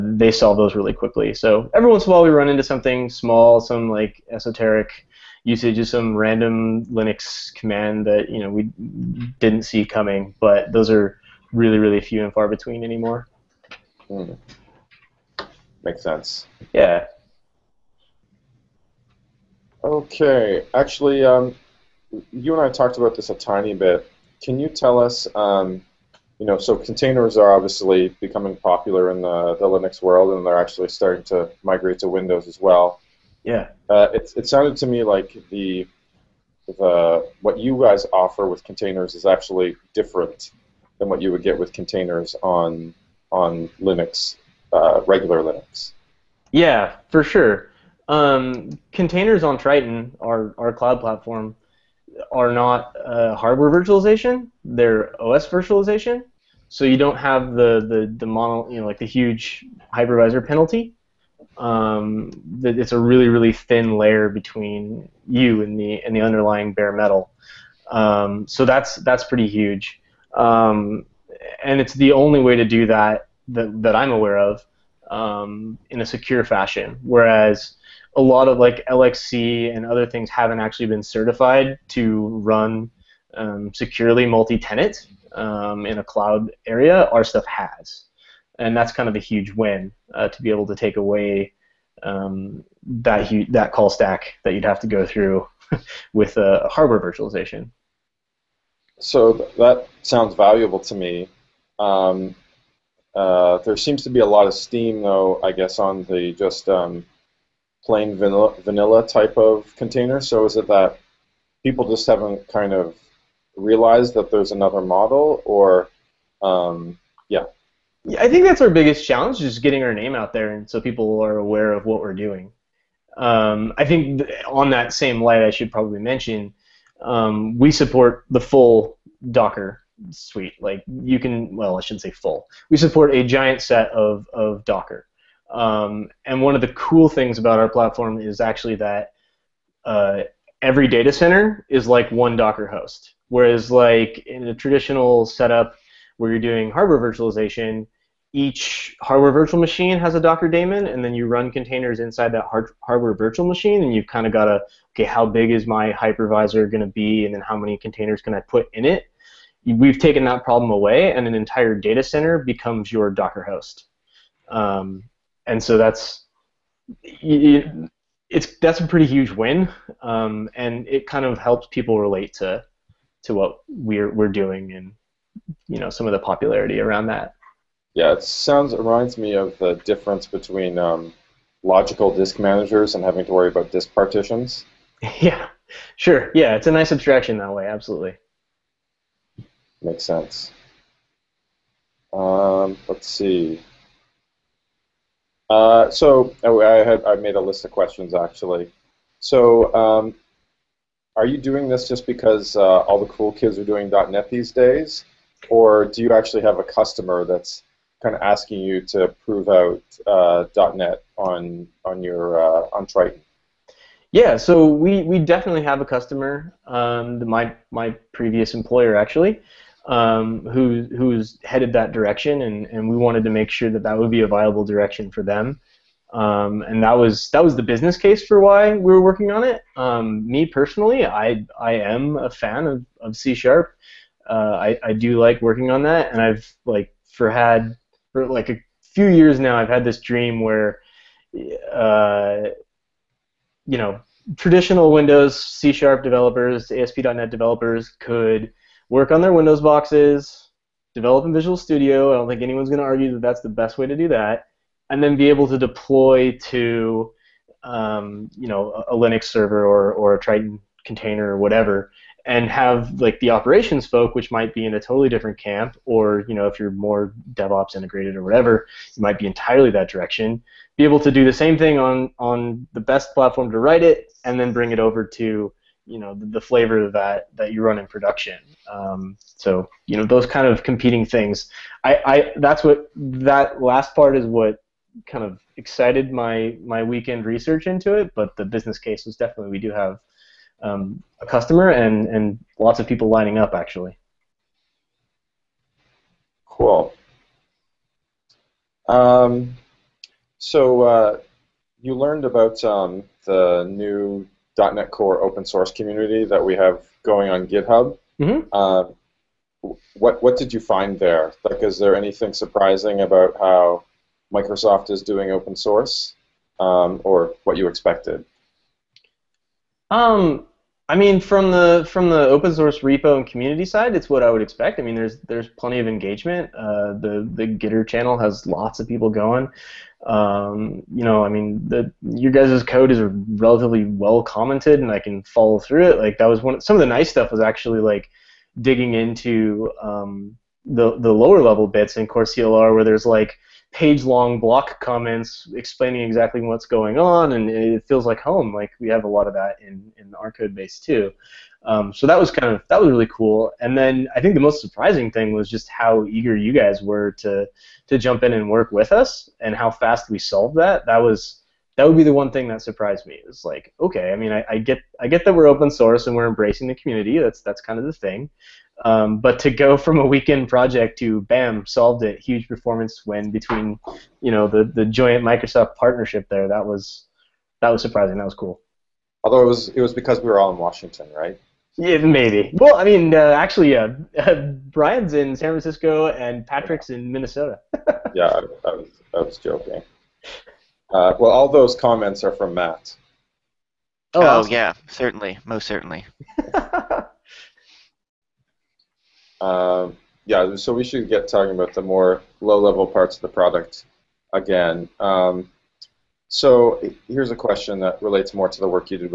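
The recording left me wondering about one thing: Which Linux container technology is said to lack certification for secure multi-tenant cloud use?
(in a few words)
LXC.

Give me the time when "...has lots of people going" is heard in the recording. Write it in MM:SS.
05:28.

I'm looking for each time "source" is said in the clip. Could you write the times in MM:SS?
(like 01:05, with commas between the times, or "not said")
05:05, 05:15, 05:22, 06:05.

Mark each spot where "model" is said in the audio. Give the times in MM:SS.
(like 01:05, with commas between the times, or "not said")
01:54.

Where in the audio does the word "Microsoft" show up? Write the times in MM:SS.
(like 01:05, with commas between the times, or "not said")
05:14, 06:15.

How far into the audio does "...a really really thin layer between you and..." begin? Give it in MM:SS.
01:02.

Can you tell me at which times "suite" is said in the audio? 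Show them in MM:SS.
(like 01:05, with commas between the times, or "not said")
02:10.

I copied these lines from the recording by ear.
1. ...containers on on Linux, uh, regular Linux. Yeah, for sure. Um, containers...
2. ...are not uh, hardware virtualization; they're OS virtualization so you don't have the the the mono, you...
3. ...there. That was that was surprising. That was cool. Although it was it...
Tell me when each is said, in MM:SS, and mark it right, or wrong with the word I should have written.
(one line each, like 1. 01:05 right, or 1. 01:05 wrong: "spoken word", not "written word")
1. 00:41 right
2. 00:52 right
3. 06:16 right.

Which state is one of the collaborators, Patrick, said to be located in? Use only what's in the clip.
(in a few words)
Minnesota.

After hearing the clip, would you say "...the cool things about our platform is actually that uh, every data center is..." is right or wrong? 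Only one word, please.
right.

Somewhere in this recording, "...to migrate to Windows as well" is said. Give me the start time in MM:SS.
00:31.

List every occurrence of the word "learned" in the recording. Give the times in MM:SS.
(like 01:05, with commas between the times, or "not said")
05:01.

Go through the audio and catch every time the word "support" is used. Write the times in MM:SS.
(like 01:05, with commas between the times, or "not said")
02:07, 02:12.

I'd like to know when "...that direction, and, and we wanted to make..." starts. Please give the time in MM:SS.
03:41.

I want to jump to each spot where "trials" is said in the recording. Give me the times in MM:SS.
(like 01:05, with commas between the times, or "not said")
not said.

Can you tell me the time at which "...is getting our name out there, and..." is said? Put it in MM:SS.
01:59.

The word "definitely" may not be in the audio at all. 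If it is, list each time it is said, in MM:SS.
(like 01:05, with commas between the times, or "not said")
03:35, 04:49.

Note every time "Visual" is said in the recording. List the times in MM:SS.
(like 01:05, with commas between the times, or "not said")
04:11.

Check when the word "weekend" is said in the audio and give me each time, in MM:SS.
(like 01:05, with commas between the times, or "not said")
04:46, 06:10.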